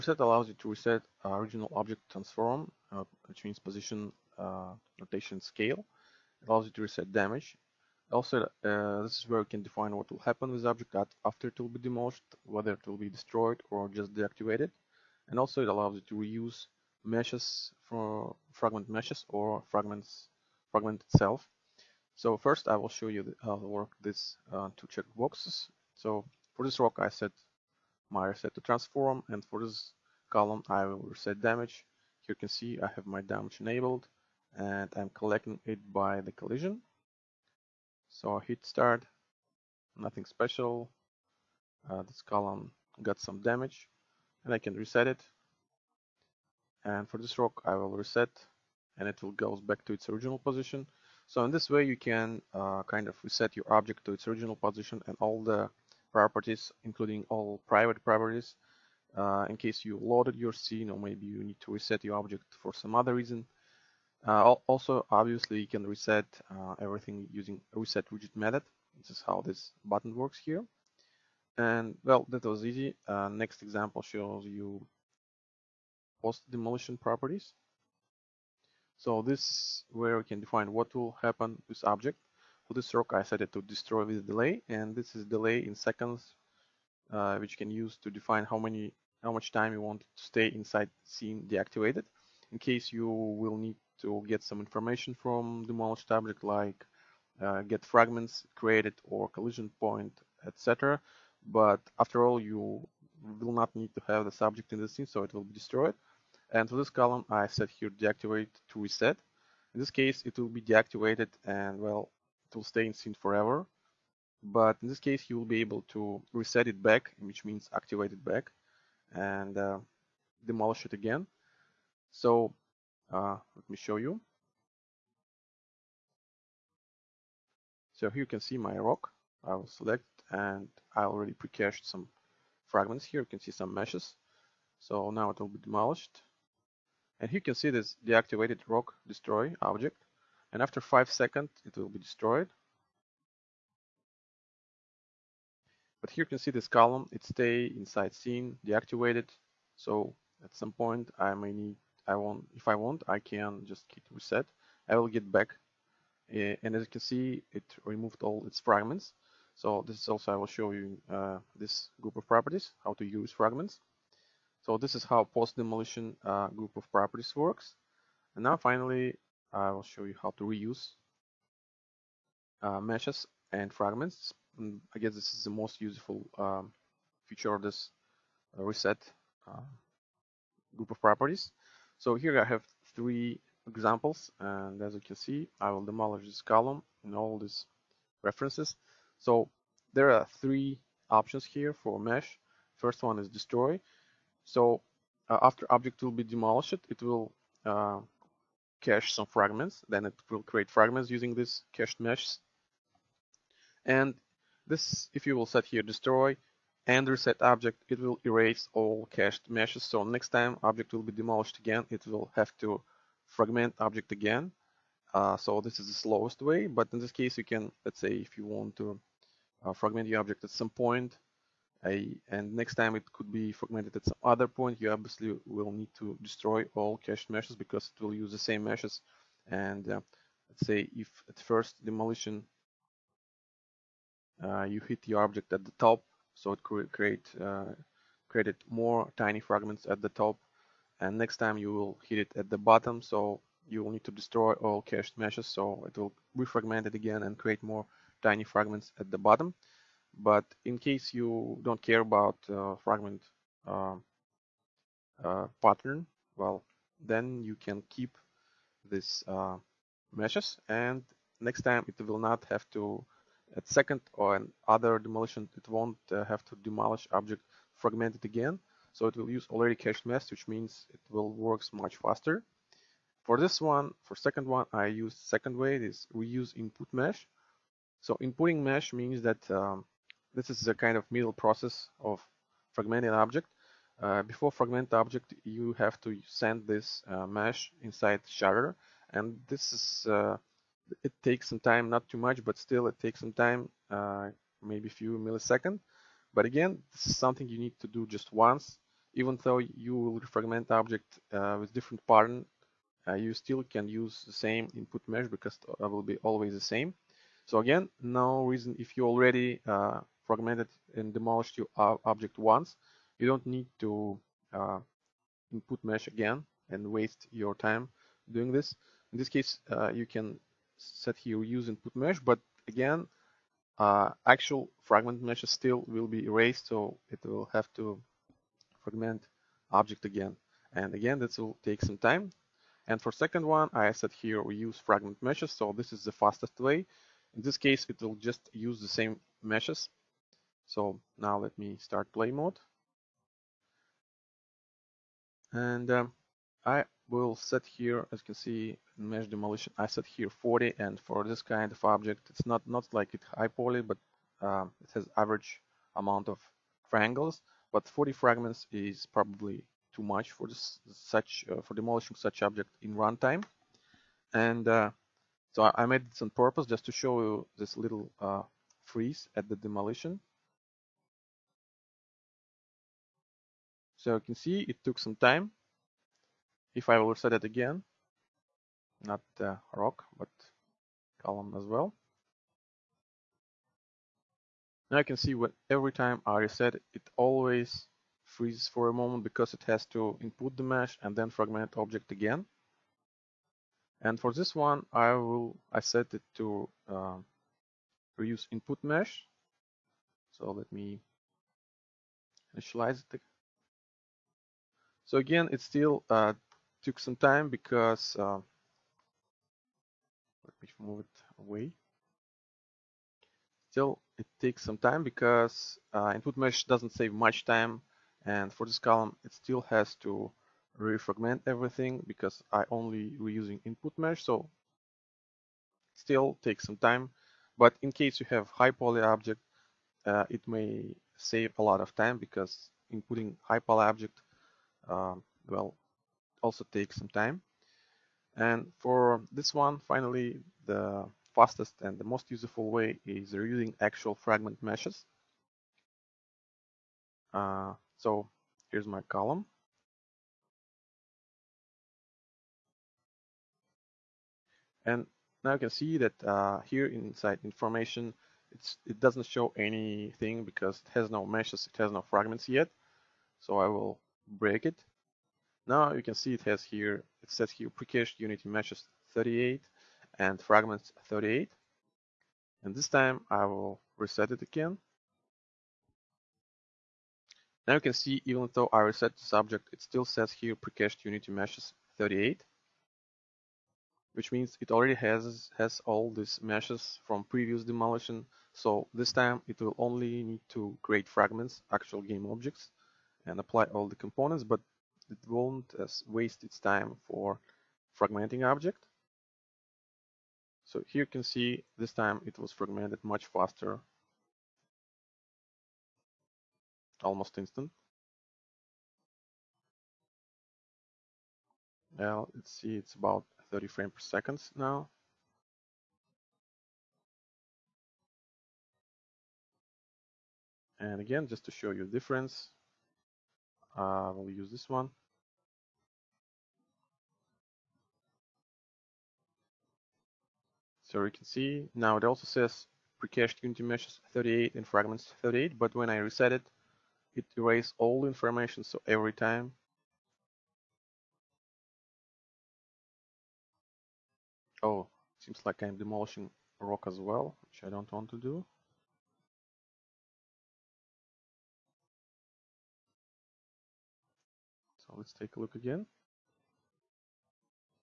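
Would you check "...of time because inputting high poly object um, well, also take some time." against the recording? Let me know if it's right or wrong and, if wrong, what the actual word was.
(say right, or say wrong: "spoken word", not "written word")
right.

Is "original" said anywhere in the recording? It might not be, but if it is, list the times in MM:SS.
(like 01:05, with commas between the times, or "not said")
00:01, 00:50, 00:54.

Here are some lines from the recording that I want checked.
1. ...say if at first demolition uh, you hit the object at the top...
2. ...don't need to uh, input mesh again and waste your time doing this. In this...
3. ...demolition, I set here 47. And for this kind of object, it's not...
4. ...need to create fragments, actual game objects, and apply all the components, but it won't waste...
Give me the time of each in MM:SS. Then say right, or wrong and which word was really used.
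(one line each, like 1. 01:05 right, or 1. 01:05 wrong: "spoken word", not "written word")
1. 03:50 right
2. 05:13 right
3. 05:49 wrong: "40", not "47"
4. 08:10 right.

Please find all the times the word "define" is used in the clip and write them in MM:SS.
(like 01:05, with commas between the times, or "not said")
00:09, 01:20, 01:28.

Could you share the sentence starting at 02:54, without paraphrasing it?
Mm, I guess this is the most useful um, feature of this uh, reset uh, group of properties.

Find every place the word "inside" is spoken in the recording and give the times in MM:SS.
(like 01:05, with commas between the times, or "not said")
01:30, 02:27, 04:47, 07:36.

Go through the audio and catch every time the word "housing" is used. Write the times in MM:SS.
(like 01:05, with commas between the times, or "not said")
not said.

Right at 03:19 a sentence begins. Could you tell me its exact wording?
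Then it will create fragments using this cached meshes.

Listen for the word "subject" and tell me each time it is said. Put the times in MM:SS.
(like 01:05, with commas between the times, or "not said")
01:44, 07:59.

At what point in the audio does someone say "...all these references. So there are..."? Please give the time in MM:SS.
03:07.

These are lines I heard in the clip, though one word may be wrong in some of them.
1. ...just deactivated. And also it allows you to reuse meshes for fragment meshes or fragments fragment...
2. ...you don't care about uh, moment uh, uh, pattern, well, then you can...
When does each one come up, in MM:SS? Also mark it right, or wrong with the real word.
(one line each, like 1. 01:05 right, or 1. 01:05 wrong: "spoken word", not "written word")
1. 00:13 right
2. 04:11 wrong: "fragment", not "moment".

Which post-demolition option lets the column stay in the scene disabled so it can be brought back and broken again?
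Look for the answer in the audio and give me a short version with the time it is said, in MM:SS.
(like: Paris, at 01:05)
deactivate to reset, at 01:47.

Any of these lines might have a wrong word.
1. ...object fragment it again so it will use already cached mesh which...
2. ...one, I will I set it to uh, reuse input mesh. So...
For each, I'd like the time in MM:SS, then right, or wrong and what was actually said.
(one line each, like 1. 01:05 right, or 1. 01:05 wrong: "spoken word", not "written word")
1. 04:27 right
2. 06:34 right.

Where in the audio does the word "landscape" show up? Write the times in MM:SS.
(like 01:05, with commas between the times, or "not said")
not said.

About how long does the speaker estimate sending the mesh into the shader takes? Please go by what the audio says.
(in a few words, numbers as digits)
few milliseconds.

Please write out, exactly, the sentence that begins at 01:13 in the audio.
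Uh, next example shows you post demolition properties.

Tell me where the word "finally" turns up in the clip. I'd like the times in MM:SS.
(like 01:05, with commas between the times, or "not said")
02:48, 07:19.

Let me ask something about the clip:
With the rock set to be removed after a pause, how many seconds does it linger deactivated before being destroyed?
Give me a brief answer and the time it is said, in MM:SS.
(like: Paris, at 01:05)
5, at 02:20.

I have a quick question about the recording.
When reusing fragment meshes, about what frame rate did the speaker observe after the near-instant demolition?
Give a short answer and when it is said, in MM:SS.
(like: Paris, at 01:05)
30 frames per second, at 08:33.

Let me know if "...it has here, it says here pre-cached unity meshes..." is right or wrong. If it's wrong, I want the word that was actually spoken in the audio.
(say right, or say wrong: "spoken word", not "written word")
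right.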